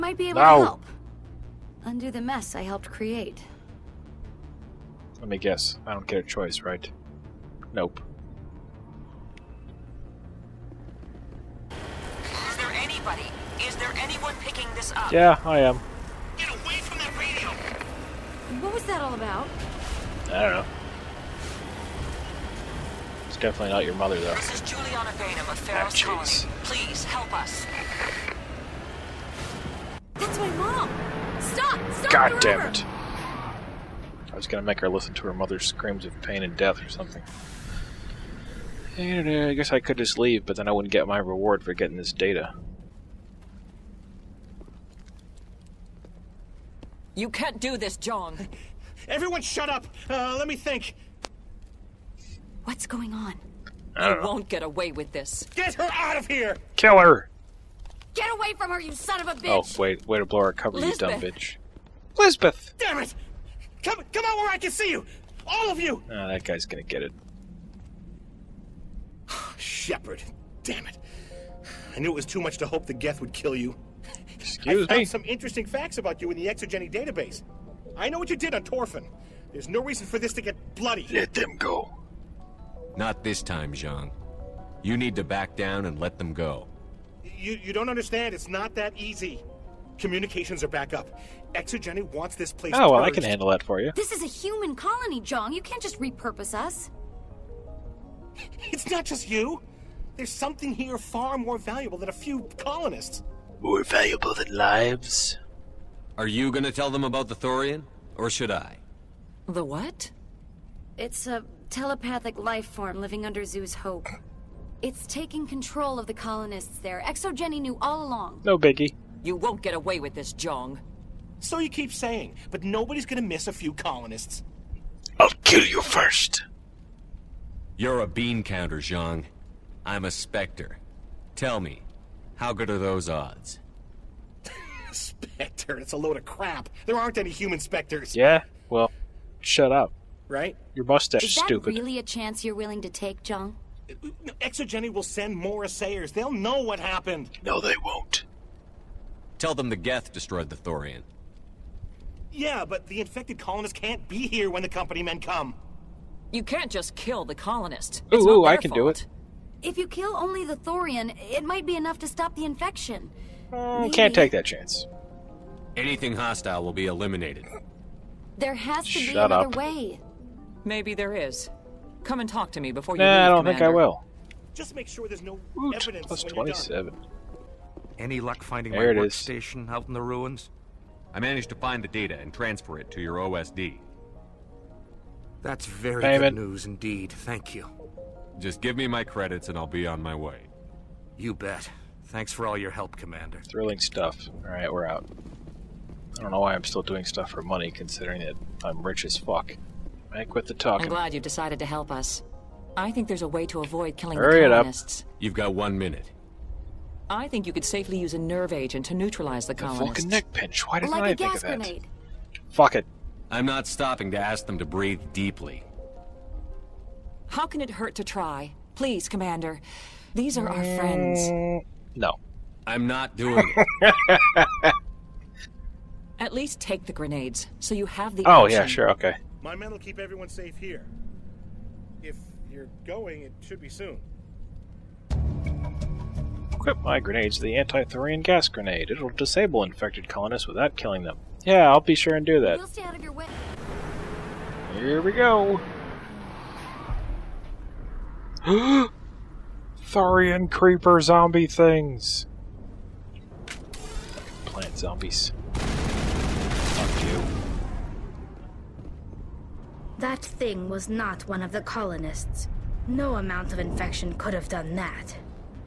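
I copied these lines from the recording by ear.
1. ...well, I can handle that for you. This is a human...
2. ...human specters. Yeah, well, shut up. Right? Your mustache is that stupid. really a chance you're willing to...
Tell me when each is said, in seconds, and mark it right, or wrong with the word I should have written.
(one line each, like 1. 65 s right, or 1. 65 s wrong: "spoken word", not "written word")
1. 92 s right
2. 137 s right.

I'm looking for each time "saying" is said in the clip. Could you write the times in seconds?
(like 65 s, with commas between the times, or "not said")
121 s.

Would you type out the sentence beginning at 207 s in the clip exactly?
I think you could safely use a nerve agent to neutralize the, the colonists.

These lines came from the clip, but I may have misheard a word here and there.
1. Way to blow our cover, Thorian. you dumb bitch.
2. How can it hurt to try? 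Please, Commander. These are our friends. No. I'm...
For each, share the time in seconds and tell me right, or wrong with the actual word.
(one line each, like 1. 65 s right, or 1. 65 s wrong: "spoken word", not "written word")
1. 60 s wrong: "Lizbeth", not "Thorian"
2. 217 s right.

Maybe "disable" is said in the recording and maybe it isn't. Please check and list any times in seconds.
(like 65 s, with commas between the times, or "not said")
239 s.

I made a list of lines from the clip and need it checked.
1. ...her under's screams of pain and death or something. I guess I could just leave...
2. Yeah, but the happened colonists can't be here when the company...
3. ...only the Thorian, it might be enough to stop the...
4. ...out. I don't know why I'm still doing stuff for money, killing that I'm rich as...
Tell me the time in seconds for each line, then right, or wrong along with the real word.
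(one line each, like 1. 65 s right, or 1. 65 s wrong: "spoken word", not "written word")
1. 35 s wrong: "mother", not "under"
2. 152 s wrong: "infected", not "happened"
3. 160 s right
4. 194 s wrong: "considering", not "killing".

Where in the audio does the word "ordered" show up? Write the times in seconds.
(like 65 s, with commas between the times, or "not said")
not said.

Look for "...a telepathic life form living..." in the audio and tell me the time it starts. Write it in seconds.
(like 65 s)
111 s.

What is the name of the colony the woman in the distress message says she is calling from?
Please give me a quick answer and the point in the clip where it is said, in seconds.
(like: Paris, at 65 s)
Feros, at 25 s.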